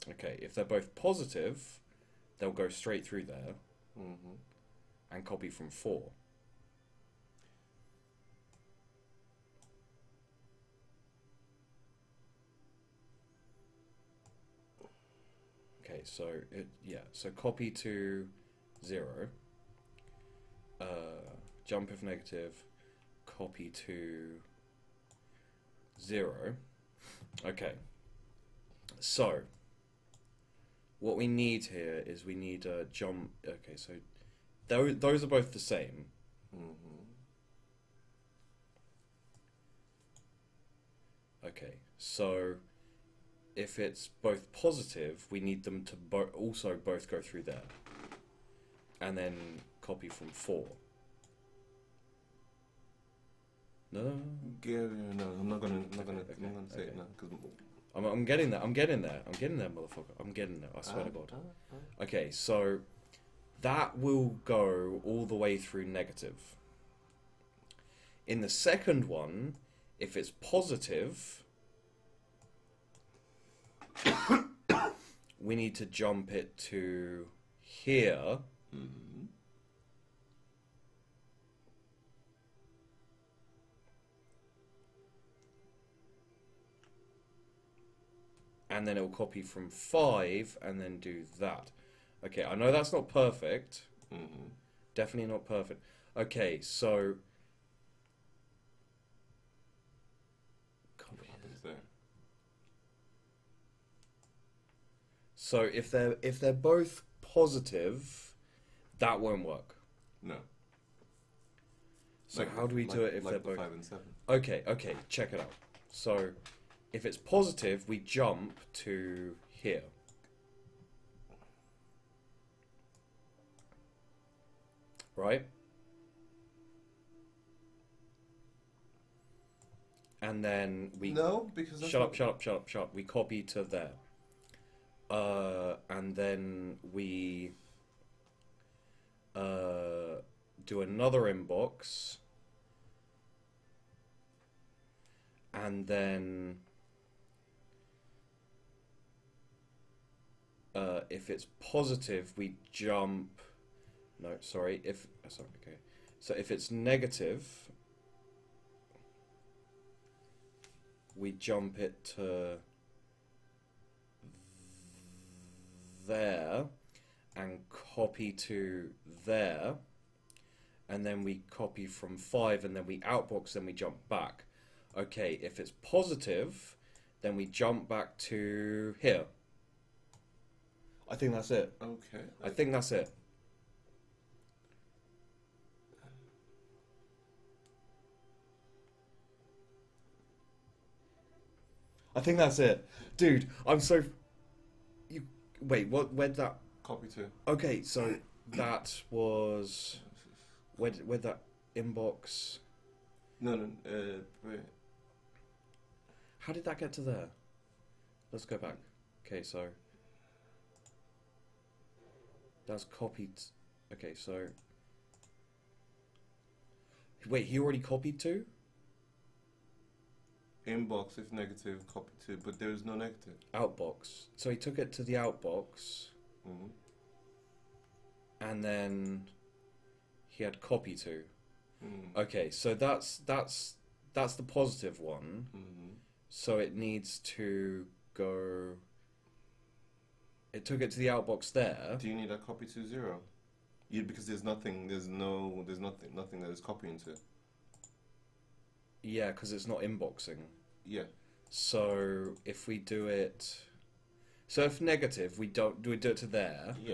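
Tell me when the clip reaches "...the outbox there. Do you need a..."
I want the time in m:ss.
4:00.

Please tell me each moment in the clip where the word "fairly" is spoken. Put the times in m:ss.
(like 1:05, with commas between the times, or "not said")
not said.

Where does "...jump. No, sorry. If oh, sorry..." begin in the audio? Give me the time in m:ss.
2:32.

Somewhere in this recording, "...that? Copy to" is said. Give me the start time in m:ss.
3:16.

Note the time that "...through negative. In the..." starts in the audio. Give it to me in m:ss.
1:05.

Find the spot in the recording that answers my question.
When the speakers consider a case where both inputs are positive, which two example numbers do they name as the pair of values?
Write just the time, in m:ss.
1:53.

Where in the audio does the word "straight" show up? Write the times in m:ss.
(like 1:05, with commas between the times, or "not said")
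0:02.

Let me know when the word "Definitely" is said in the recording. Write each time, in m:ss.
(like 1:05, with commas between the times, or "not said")
1:34.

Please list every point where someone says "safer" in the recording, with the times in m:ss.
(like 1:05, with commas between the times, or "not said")
not said.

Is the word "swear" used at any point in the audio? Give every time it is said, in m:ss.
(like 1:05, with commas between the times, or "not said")
1:00.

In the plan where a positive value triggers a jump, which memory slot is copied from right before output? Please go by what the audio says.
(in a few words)
5.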